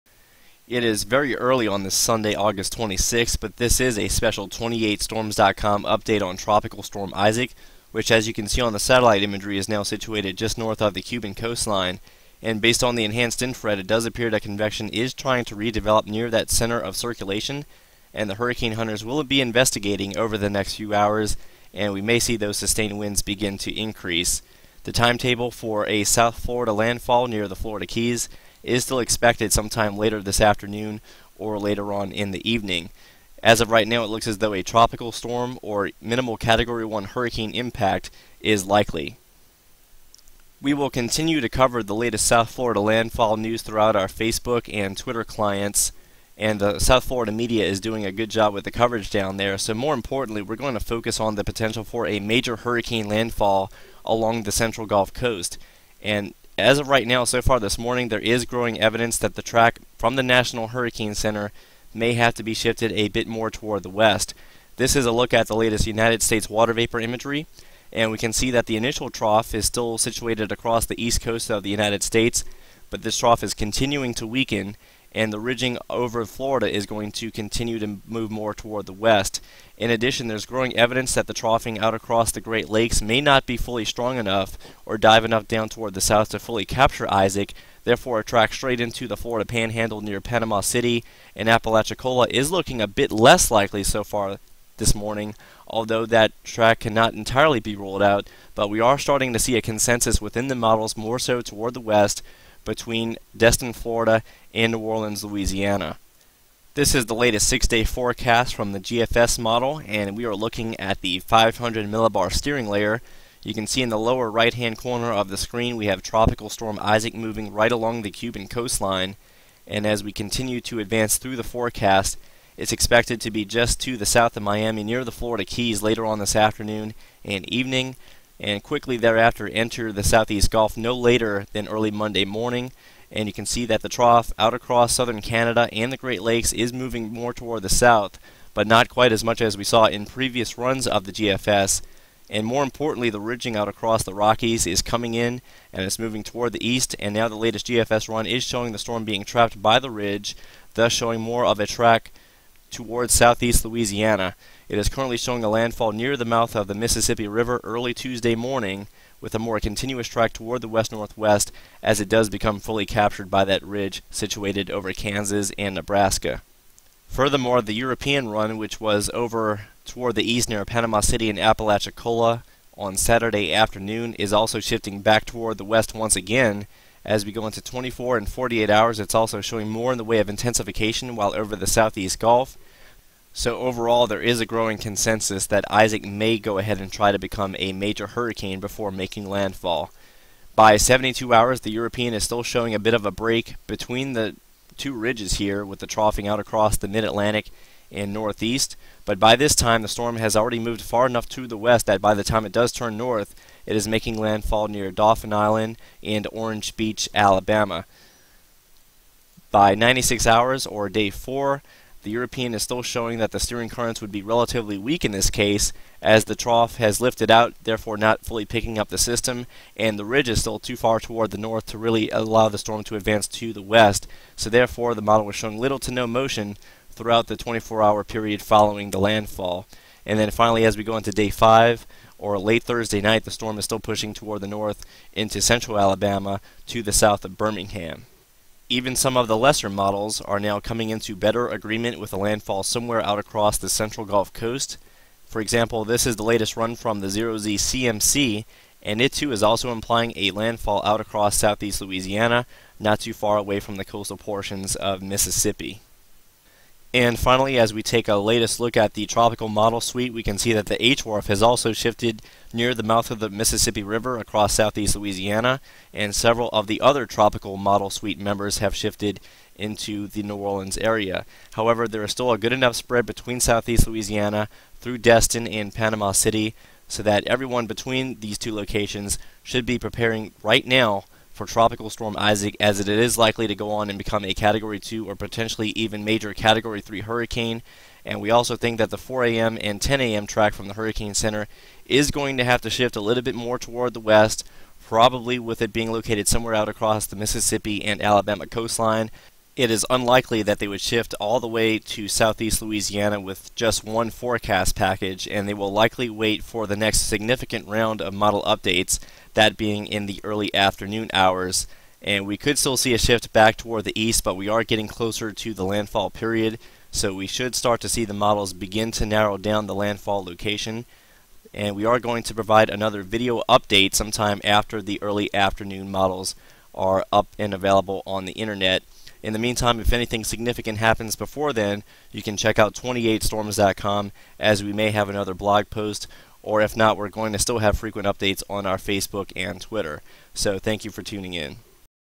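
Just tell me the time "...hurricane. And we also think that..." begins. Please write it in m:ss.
4:47.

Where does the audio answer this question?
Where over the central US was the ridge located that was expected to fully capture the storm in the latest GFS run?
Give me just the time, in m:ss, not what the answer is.
2:44.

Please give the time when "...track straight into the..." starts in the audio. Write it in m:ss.
1:28.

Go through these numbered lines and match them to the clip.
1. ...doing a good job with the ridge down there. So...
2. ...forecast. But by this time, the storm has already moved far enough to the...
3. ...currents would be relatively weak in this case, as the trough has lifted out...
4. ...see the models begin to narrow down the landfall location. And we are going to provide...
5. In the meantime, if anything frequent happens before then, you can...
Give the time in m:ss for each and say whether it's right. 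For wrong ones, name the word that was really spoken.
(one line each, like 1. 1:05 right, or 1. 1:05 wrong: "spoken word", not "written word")
1. 0:47 wrong: "coverage", not "ridge"
2. 3:18 wrong: "northeast", not "forecast"
3. 3:33 right
4. 5:17 right
5. 5:29 wrong: "significant", not "frequent".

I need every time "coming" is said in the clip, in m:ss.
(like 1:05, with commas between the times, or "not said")
2:24, 4:00.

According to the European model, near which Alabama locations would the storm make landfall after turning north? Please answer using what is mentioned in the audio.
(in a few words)
Dauphin Island and Orange Beach.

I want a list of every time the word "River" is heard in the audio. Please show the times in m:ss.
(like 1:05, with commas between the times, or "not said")
2:37, 4:23.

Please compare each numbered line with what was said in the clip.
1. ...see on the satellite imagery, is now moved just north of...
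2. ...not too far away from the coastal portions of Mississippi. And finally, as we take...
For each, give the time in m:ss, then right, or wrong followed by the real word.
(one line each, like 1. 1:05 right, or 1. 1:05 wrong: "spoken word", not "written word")
1. 0:08 wrong: "situated", not "moved"
2. 4:12 right.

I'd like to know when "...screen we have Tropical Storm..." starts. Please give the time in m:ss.
1:55.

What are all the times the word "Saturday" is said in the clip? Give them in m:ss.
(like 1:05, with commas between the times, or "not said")
2:52.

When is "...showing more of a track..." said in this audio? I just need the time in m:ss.
2:30.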